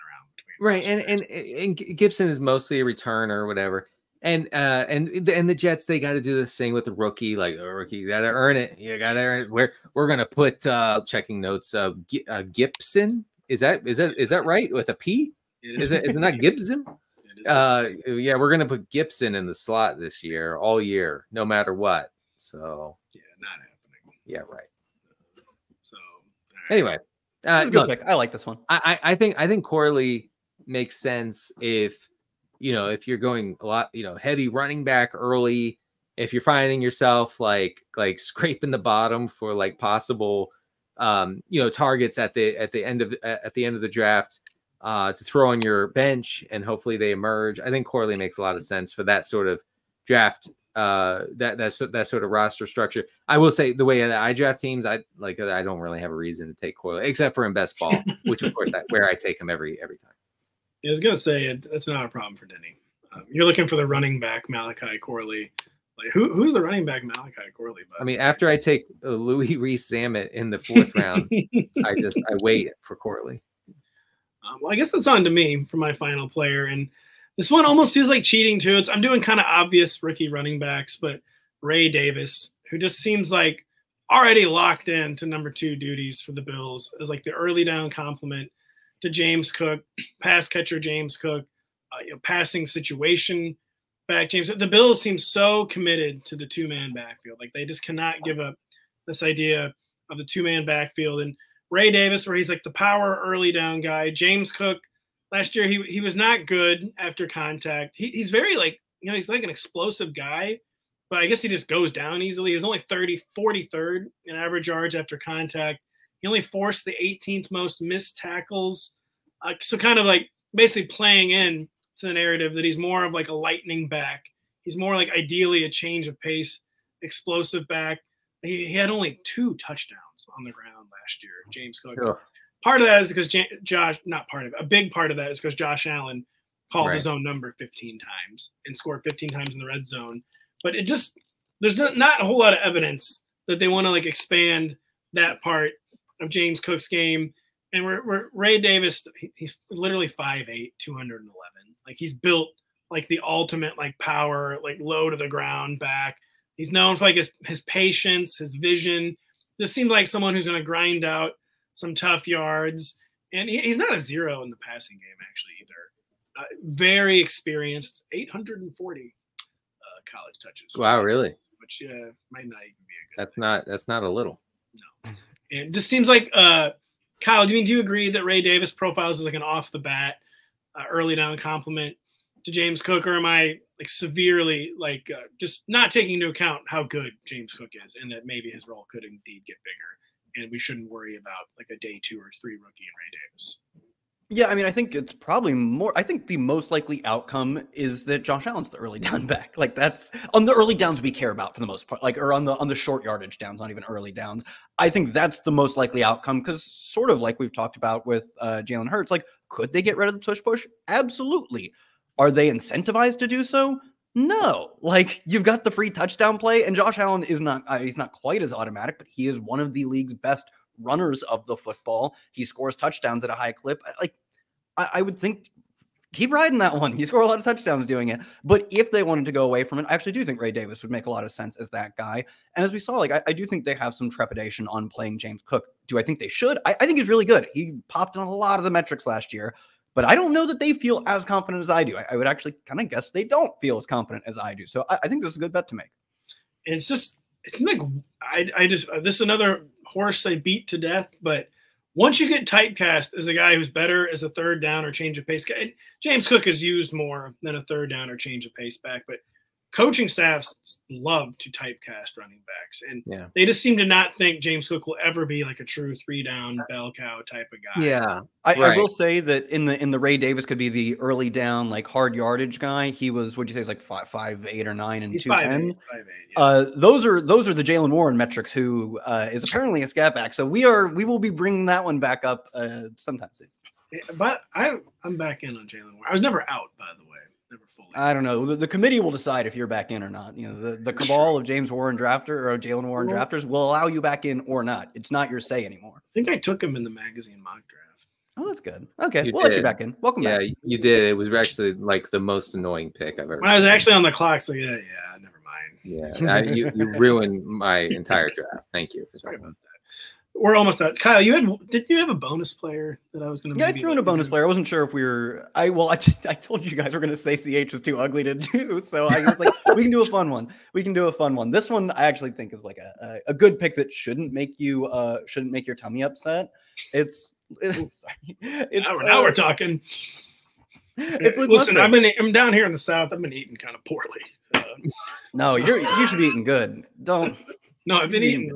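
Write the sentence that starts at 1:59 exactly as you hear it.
Uh, so kind of like basically playing in to the narrative that he's more of like a lightning back.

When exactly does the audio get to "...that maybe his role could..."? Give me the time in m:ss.
3:08.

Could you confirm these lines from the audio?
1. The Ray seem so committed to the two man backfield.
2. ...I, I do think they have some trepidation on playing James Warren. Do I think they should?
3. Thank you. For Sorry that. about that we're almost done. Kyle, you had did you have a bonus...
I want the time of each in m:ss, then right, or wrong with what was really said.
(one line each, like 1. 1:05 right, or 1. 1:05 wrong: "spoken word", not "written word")
1. 1:34 wrong: "Bills", not "Ray"
2. 3:53 wrong: "Cook", not "Warren"
3. 5:08 right.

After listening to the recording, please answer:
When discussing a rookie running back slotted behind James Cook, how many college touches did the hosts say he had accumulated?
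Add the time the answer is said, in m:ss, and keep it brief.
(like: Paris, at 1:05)
840, at 2:48.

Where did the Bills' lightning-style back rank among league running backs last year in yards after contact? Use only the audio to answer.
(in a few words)
43rd.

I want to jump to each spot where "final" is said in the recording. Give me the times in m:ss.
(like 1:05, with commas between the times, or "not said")
1:15.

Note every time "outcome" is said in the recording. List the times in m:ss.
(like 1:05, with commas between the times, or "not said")
3:17, 3:26.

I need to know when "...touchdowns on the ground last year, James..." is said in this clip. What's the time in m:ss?
2:09.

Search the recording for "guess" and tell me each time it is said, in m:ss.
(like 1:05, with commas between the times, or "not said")
1:14, 1:51, 4:02.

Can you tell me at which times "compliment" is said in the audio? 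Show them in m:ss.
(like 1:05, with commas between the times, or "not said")
1:27, 3:01.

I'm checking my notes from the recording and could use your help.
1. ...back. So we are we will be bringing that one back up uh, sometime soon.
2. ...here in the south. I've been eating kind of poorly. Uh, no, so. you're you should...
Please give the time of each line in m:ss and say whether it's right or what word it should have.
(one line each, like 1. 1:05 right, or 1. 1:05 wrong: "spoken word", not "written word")
1. 4:40 right
2. 5:32 right.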